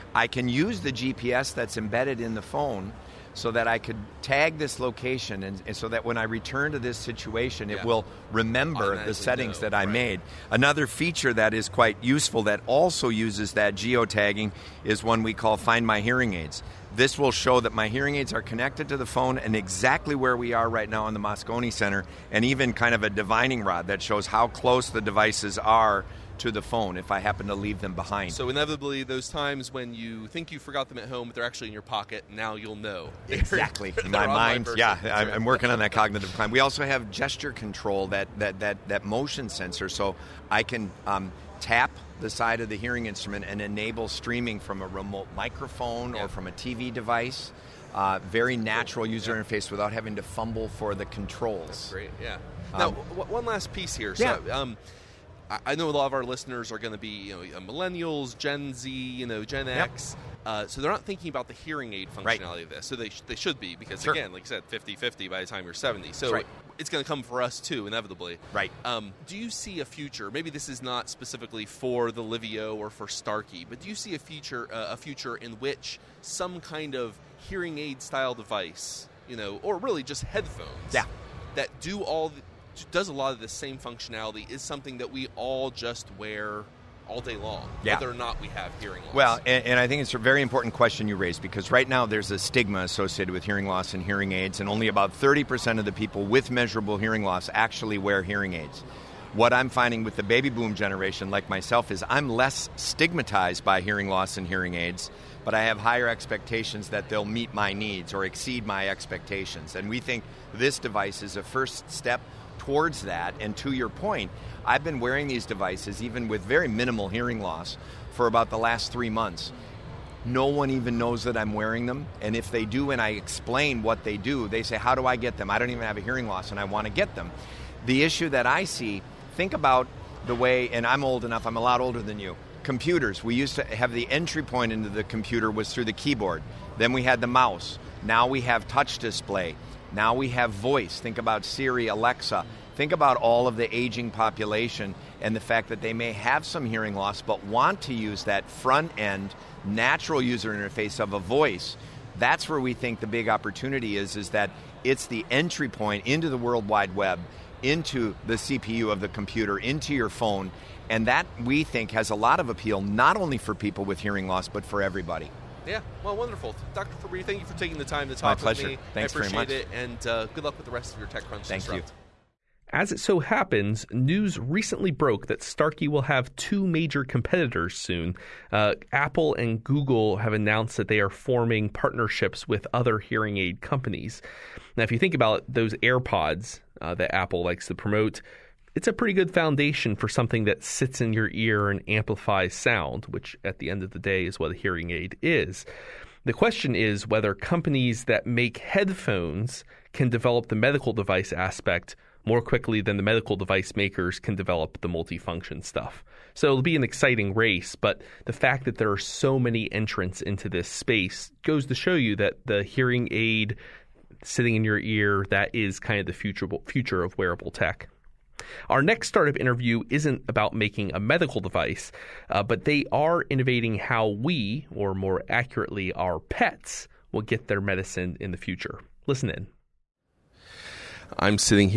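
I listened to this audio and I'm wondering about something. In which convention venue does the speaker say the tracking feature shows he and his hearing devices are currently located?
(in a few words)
Moscone Center.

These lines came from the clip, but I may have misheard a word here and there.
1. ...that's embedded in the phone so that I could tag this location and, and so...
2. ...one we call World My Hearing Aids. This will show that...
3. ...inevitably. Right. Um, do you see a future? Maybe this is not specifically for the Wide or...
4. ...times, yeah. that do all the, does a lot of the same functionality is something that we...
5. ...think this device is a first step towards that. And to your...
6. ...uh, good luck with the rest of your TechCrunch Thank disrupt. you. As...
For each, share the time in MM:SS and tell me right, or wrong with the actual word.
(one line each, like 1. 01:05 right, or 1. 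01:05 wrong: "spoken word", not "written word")
1. 00:01 right
2. 00:15 wrong: "Find", not "World"
3. 01:07 wrong: "Livio", not "Wide"
4. 01:20 wrong: "headphones", not "times"
5. 01:49 right
6. 02:50 right.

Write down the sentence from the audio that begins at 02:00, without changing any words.
No one even knows that I'm wearing them.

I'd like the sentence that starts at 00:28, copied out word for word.
So inevitably, those times when you think you forgot them at home, but they're actually in your pocket, now you'll know.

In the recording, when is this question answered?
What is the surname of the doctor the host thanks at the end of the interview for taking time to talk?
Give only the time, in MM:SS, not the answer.
02:47.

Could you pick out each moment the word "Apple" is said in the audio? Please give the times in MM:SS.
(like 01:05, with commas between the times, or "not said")
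02:58, 03:07.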